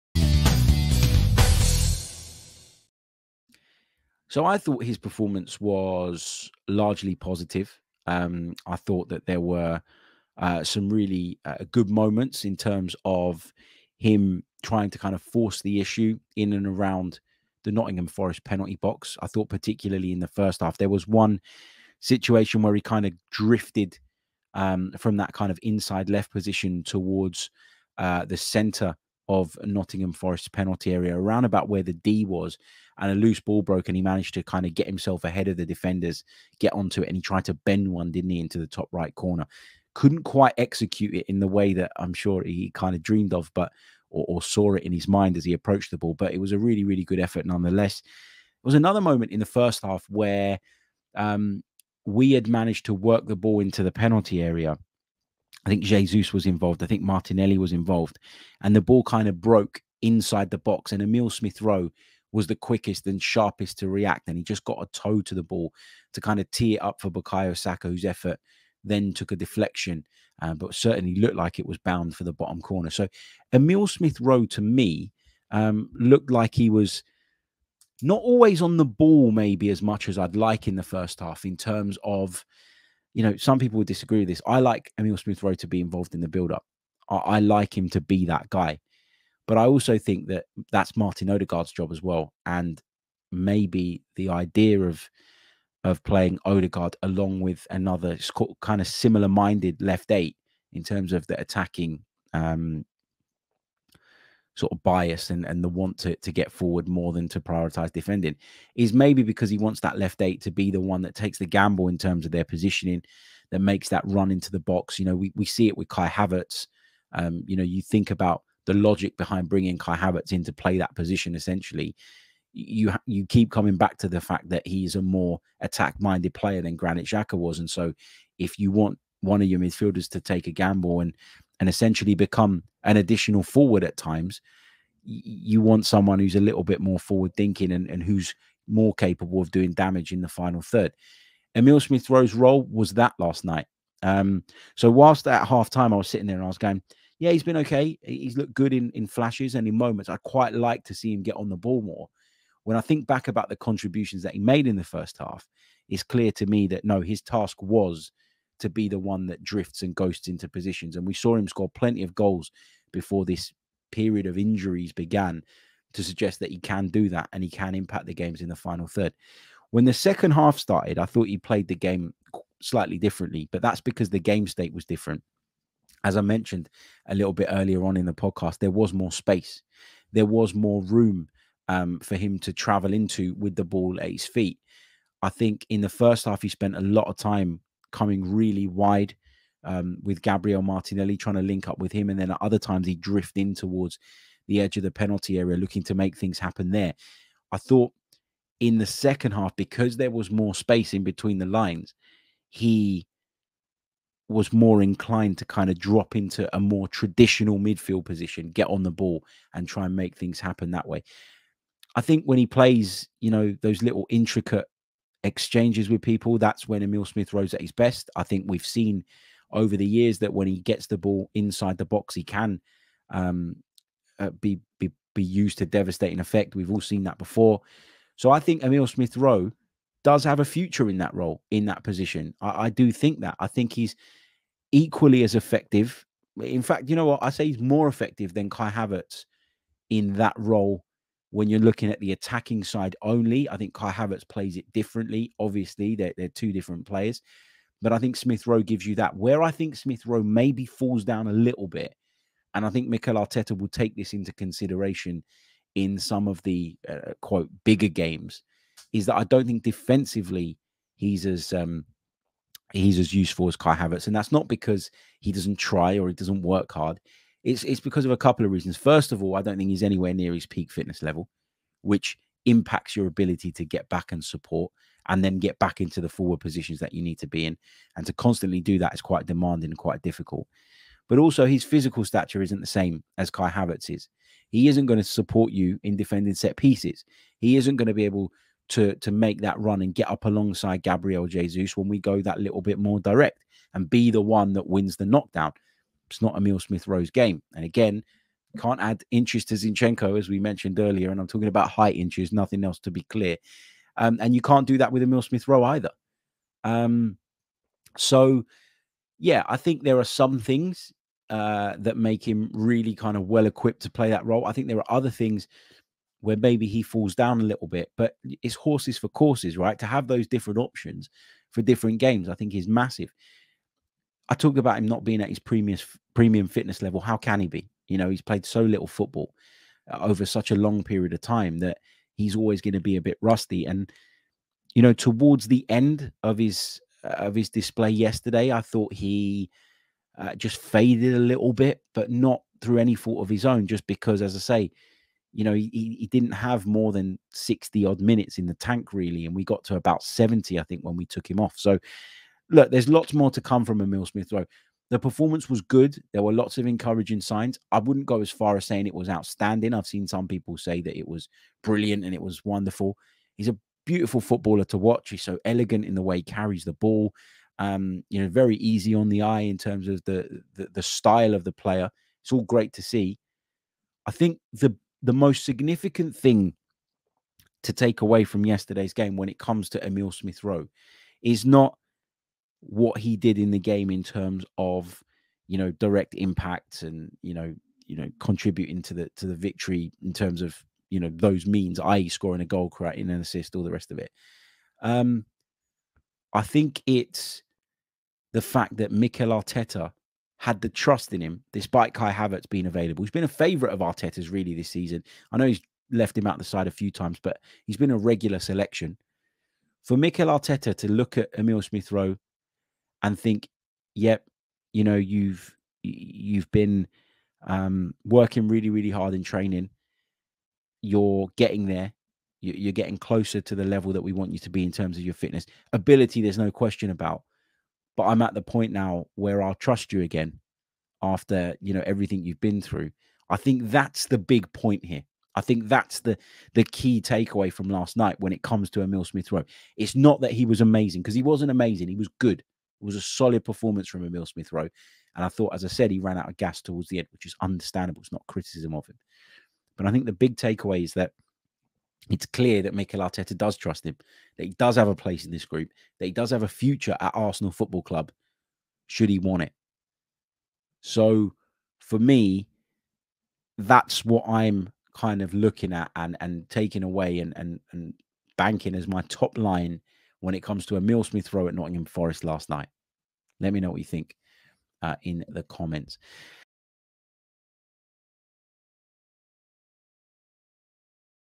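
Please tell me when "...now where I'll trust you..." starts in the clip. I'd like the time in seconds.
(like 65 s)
428 s.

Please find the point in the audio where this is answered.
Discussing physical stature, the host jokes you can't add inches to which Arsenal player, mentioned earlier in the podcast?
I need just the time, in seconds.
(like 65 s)
299 s.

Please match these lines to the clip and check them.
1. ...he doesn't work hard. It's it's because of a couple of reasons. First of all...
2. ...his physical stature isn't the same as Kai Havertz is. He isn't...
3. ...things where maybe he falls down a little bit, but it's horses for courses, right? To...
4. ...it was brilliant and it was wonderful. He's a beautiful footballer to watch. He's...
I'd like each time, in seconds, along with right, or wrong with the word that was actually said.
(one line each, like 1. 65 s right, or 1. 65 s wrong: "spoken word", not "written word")
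1. 266 s right
2. 281 s right
3. 315 s right
4. 360 s right.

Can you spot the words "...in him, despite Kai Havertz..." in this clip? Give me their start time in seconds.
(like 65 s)
401 s.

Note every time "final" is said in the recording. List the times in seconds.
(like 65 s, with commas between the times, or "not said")
140 s, 168 s.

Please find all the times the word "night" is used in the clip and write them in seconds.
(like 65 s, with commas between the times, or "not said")
143 s, 437 s, 472 s.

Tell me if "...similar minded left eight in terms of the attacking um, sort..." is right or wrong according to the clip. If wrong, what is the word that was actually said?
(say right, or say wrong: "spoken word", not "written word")
right.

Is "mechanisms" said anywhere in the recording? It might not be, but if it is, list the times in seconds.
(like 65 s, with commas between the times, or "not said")
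not said.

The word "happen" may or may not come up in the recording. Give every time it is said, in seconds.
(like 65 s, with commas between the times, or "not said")
196 s, 210 s.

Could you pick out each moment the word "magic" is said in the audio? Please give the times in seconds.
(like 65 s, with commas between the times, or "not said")
not said.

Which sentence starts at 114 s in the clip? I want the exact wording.
You know, we, we see it with Kai Havertz.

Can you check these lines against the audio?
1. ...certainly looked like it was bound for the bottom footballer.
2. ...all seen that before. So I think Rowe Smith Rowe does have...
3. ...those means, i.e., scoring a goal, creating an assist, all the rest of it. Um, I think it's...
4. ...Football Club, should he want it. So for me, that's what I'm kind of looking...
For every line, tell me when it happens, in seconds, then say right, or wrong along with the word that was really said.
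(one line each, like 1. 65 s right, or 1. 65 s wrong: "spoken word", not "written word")
1. 70 s wrong: "corner", not "footballer"
2. 226 s wrong: "Emile", not "Rowe"
3. 391 s right
4. 457 s right.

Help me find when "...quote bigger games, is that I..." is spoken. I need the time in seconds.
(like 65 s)
257 s.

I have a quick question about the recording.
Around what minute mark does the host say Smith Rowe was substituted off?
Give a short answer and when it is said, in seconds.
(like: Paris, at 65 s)
70, at 350 s.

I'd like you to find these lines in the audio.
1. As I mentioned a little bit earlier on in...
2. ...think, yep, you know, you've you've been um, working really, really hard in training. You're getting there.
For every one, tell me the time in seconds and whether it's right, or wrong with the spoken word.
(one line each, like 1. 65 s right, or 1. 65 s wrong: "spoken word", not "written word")
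1. 176 s right
2. 413 s right.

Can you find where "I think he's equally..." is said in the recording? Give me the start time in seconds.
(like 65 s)
233 s.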